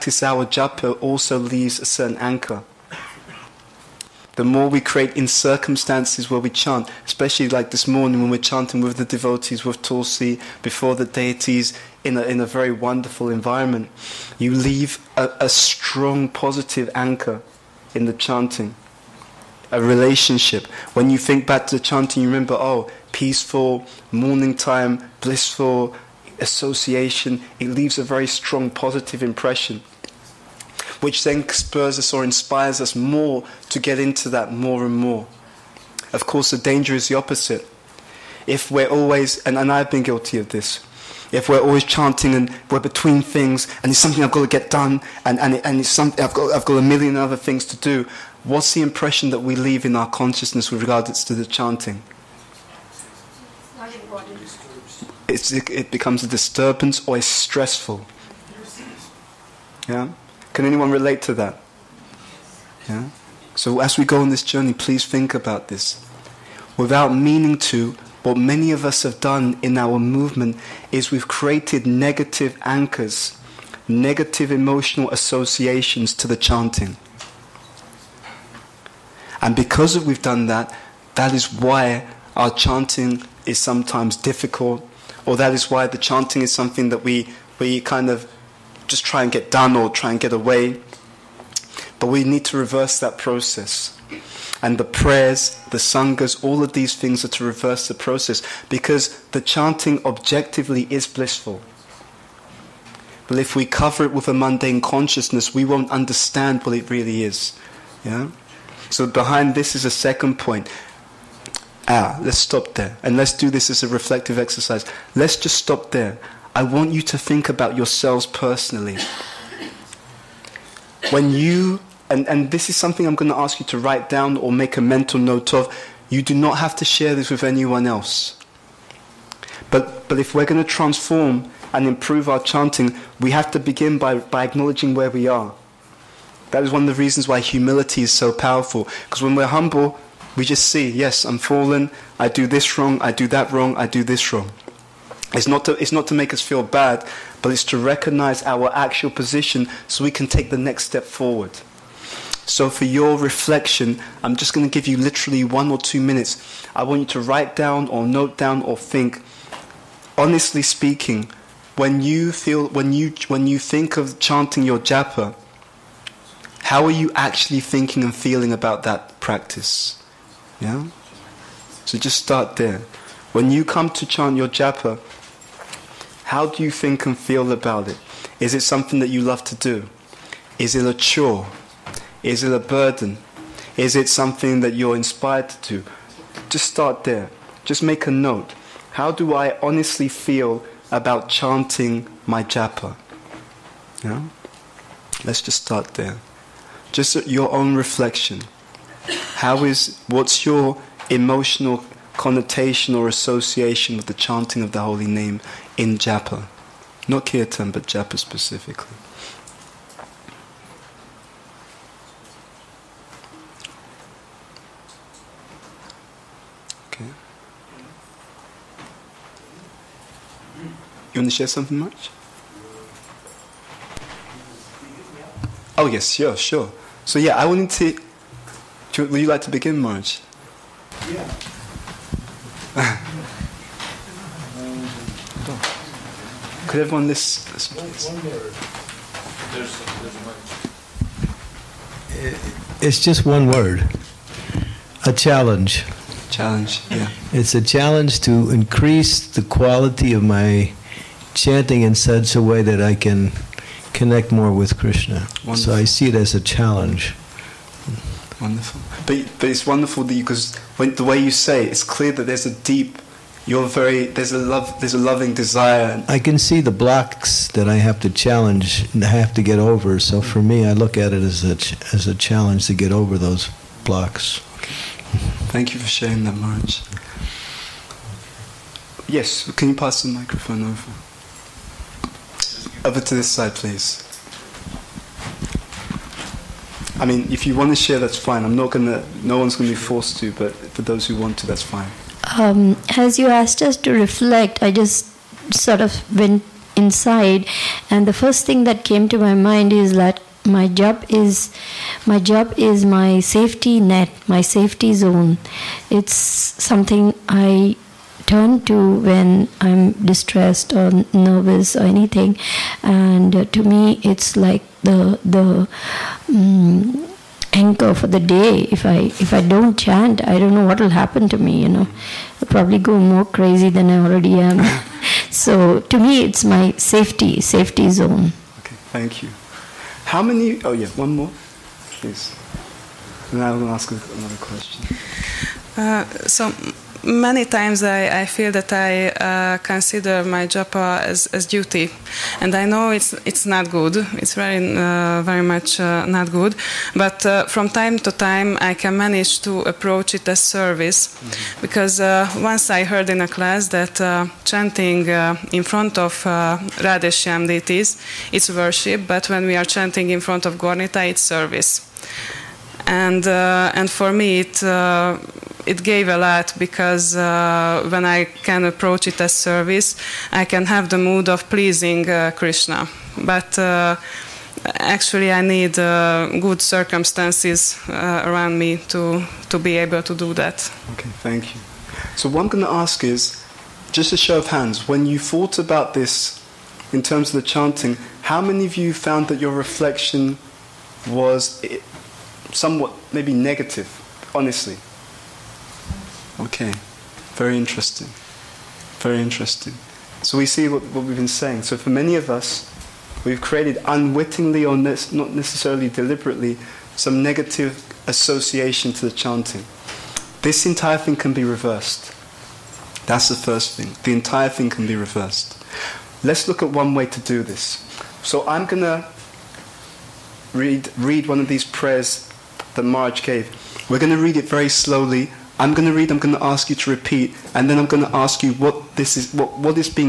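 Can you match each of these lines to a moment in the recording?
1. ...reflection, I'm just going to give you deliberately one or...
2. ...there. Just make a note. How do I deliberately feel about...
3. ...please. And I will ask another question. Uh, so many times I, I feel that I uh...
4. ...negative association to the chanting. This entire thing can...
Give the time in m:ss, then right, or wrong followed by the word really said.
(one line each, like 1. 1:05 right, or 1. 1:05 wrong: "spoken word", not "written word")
1. 2:33 wrong: "literally", not "deliberately"
2. 3:07 wrong: "honestly", not "deliberately"
3. 5:31 right
4. 6:47 right.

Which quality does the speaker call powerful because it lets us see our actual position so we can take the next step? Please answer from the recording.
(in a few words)
humility.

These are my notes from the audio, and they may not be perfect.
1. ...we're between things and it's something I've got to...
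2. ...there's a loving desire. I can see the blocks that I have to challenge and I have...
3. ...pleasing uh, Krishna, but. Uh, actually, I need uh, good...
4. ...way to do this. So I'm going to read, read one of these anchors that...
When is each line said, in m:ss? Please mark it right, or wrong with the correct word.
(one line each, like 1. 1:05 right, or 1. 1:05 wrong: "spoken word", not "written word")
1. 0:42 right
2. 4:24 right
3. 6:11 right
4. 6:56 wrong: "prayers", not "anchors".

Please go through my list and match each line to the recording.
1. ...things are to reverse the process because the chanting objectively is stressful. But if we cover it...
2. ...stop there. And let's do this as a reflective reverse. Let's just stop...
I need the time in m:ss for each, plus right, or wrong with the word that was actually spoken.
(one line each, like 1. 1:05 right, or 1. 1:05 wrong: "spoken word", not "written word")
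1. 1:36 wrong: "blissful", not "stressful"
2. 1:52 wrong: "exercise", not "reverse".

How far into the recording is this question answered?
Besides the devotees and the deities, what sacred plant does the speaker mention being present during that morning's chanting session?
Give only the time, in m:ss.
0:09.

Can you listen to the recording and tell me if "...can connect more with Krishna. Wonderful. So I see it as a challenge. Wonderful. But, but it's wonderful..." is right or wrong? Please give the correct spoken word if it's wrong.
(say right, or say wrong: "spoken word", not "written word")
right.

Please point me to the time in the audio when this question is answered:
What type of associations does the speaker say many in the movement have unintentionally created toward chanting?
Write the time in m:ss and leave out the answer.
1:11.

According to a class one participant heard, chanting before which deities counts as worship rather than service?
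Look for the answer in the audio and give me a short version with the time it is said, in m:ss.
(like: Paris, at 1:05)
Radhesham, at 5:56.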